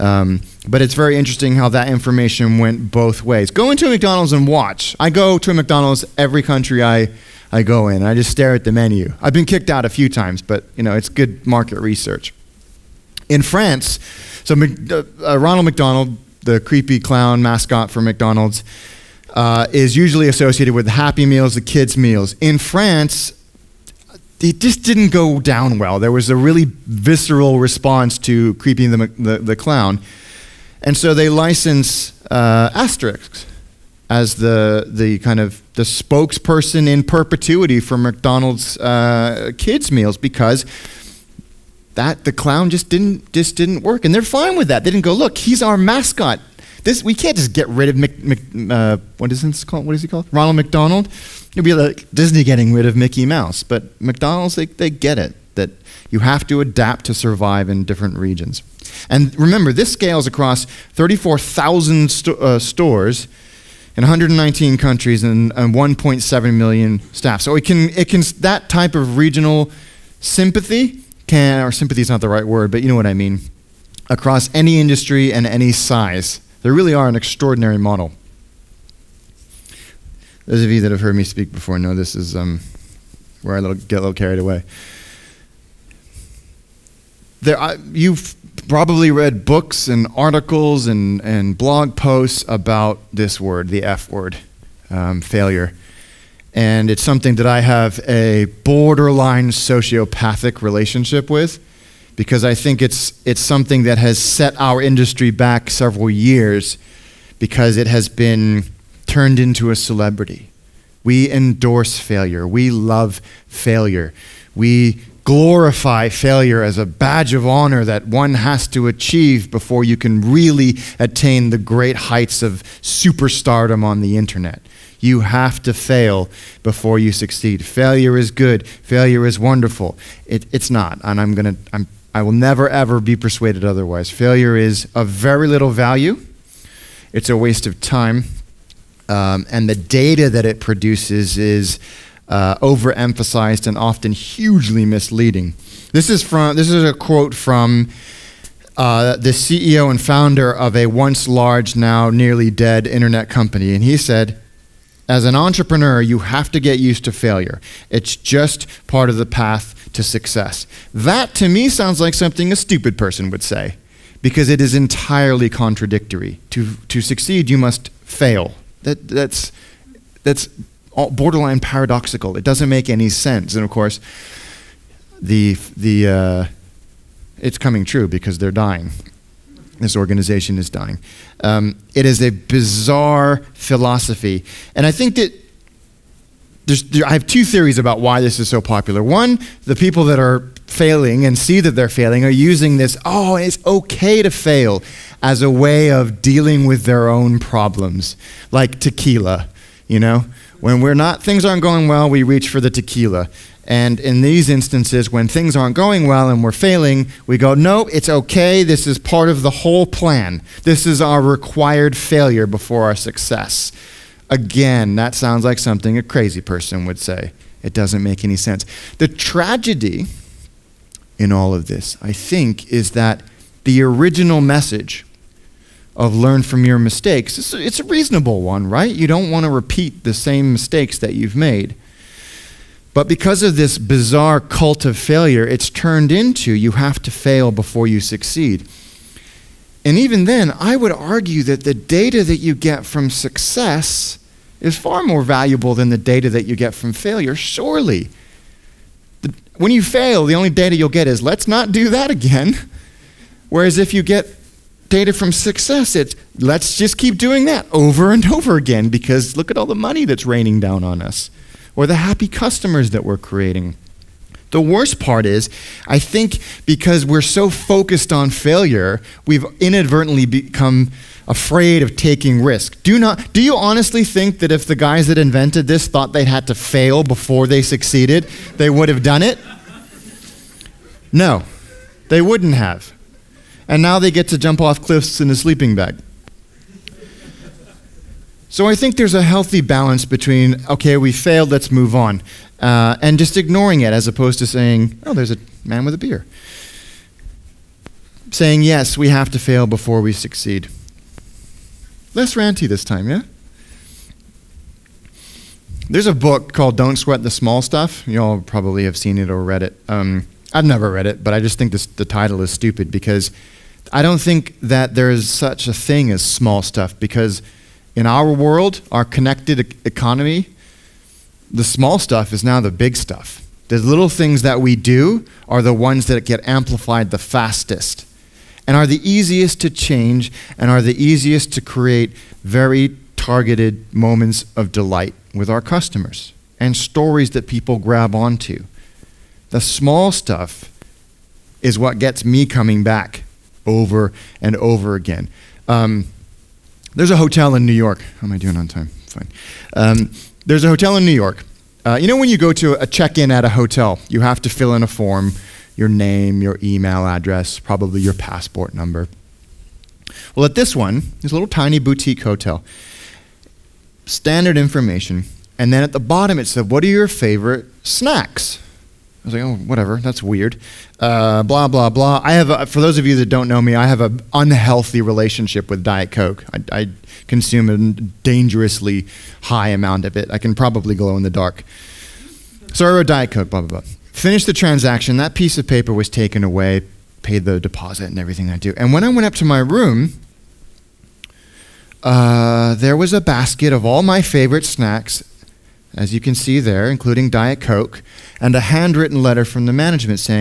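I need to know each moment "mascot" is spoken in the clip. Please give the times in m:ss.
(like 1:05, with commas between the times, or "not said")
0:17, 0:45.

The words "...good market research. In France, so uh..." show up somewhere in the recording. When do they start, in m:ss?
0:11.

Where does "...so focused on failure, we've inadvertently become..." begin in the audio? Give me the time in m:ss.
4:27.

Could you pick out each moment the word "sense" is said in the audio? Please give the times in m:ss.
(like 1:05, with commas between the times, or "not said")
2:53, 3:38.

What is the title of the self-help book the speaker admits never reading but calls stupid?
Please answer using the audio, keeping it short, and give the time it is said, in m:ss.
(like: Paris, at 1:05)
Don't Sweat the Small Stuff, at 5:06.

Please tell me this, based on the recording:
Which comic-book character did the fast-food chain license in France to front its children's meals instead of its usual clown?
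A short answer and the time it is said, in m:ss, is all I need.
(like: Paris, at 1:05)
Asterix, at 0:32.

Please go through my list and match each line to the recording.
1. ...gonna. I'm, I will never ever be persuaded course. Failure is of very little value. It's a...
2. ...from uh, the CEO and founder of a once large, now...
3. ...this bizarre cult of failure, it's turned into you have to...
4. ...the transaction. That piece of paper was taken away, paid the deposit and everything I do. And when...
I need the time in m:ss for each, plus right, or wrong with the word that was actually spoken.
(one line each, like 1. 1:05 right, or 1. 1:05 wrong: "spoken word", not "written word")
1. 2:11 wrong: "otherwise", not "course"
2. 2:27 right
3. 3:53 right
4. 6:24 right.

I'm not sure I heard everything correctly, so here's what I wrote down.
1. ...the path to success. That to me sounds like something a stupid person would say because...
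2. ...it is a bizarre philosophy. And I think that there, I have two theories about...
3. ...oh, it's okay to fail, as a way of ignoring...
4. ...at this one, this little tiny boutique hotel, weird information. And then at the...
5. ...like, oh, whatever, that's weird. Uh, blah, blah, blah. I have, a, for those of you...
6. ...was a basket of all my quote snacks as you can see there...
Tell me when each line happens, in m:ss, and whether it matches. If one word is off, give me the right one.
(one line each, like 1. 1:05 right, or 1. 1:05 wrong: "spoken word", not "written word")
1. 2:39 right
2. 3:01 right
3. 3:13 wrong: "dealing", not "ignoring"
4. 6:00 wrong: "standard", not "weird"
5. 6:09 right
6. 6:32 wrong: "favorite", not "quote".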